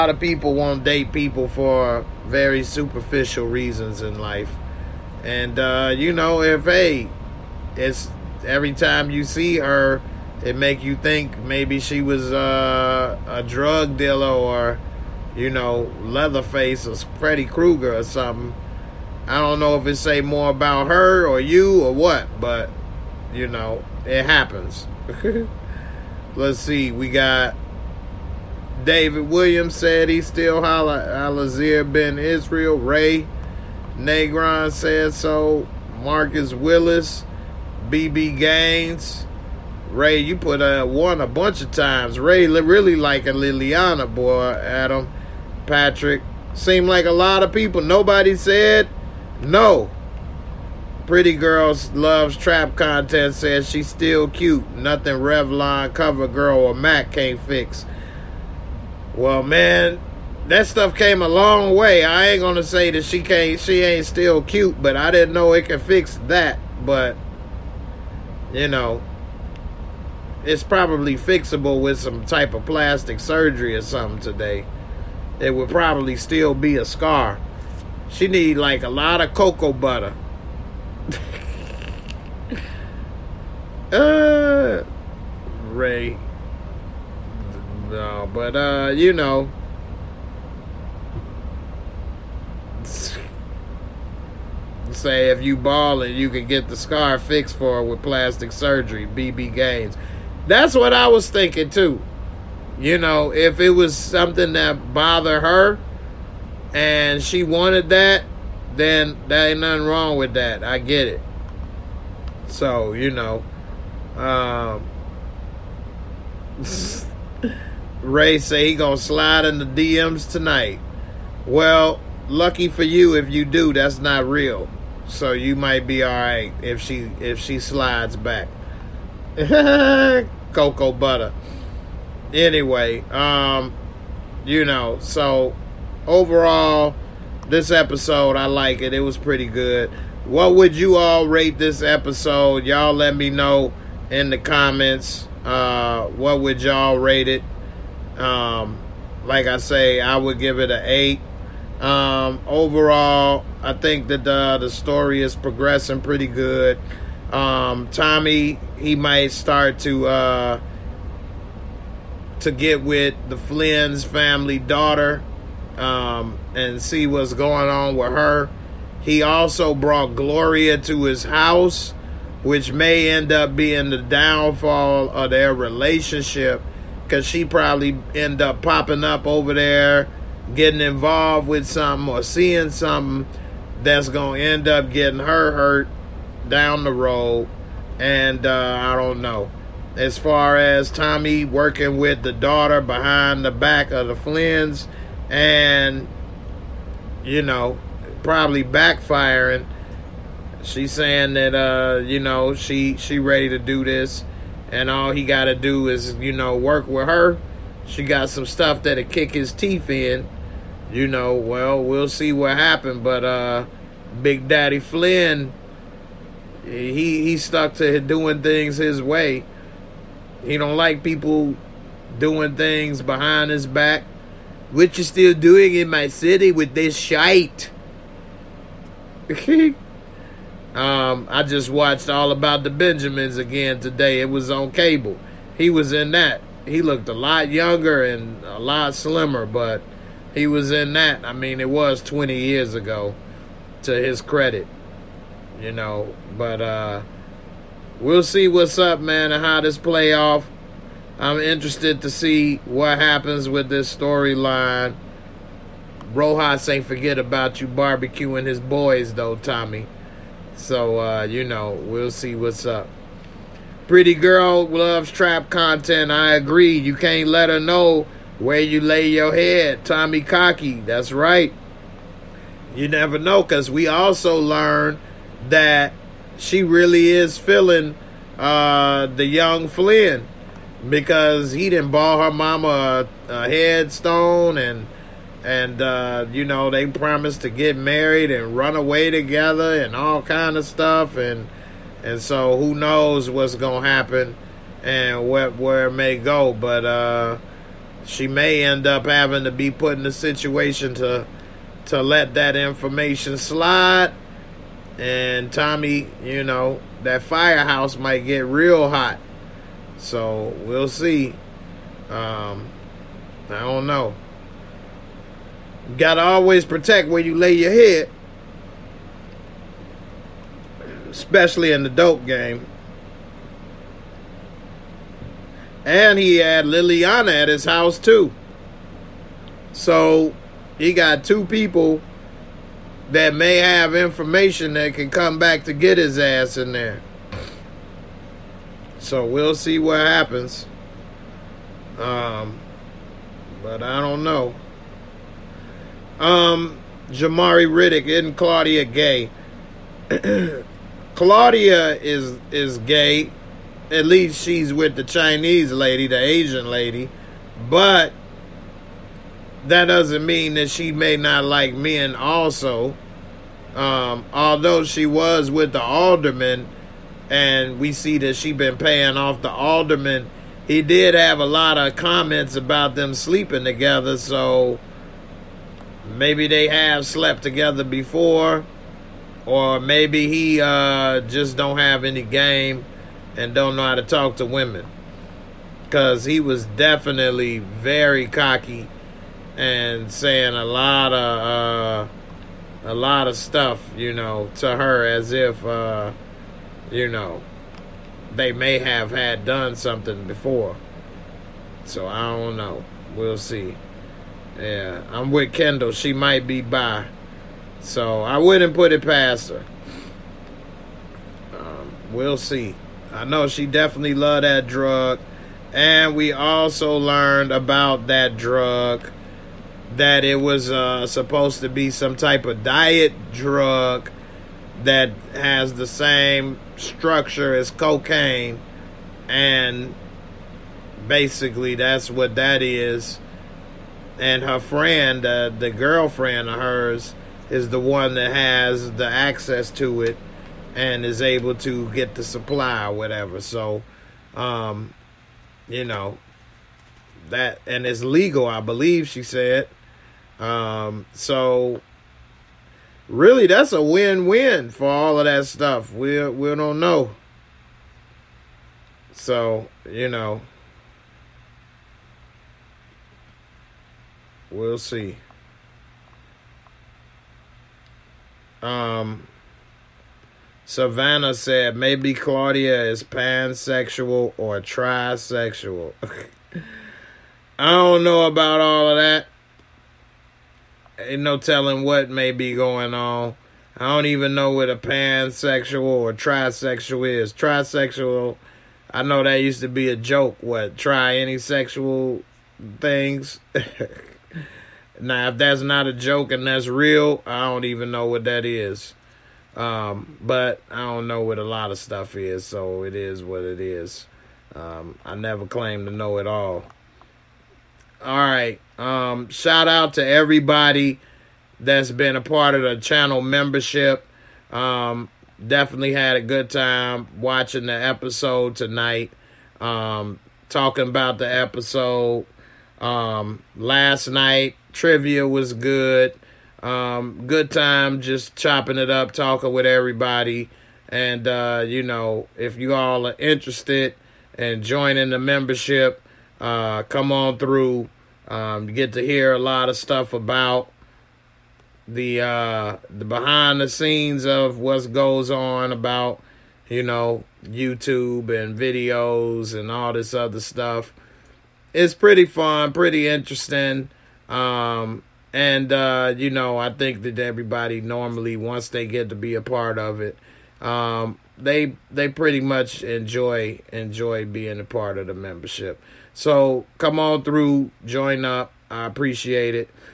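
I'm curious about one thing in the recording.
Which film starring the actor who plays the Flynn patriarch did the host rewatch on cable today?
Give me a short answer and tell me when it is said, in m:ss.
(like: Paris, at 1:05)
All About the Benjamins, at 3:52.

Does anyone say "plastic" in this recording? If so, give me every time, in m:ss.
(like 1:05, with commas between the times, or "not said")
1:12, 1:38.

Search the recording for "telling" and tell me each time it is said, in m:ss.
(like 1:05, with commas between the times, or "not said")
8:01.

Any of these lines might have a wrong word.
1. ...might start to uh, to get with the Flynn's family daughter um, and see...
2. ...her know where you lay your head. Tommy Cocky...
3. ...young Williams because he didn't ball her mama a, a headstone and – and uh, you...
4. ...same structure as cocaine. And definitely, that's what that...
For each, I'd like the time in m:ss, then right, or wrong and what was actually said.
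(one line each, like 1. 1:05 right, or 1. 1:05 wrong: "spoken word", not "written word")
1. 2:38 right
2. 4:27 right
3. 4:39 wrong: "Flynn", not "Williams"
4. 7:05 wrong: "basically", not "definitely".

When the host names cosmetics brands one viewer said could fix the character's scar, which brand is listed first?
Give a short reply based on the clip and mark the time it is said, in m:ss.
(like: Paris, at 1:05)
Revlon, at 0:55.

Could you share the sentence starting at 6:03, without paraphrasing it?
Um, although she was with the alderman, and we see that she been paying off the alderman.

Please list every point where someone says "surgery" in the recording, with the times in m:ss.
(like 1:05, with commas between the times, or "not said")
1:13, 1:38.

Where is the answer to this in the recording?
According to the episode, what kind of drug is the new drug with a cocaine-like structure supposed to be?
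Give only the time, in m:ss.
7:02.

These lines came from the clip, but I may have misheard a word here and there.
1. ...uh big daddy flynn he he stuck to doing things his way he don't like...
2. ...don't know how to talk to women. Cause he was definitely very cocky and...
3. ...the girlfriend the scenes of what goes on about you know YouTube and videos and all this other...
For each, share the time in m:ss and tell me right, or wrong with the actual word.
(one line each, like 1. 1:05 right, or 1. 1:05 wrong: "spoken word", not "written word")
1. 3:33 right
2. 6:23 right
3. 9:02 wrong: "behind", not "girlfriend".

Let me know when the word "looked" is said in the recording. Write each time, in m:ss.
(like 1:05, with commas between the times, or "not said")
3:56.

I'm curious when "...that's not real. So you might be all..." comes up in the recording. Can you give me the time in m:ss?
2:03.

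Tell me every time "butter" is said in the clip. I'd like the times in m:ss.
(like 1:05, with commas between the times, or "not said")
1:19, 2:10.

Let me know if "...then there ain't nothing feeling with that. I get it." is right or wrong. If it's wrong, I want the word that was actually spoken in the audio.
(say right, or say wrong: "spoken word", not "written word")
wrong: "wrong", not "feeling".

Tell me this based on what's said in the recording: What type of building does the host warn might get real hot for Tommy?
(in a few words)
Firehouse.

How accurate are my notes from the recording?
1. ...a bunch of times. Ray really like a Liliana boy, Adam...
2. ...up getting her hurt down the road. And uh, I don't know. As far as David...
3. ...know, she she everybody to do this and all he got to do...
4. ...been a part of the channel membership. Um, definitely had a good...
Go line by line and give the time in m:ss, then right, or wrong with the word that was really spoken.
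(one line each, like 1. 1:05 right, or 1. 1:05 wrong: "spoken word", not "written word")
1. 0:41 right
2. 3:04 wrong: "Tommy", not "David"
3. 3:22 wrong: "ready", not "everybody"
4. 8:31 right.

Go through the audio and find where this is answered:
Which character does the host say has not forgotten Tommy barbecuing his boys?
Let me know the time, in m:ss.
4:16.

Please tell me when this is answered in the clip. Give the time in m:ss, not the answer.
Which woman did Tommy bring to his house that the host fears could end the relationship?
2:50.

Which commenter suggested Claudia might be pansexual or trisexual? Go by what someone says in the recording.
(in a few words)
Savannah.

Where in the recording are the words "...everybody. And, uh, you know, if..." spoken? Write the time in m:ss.
8:49.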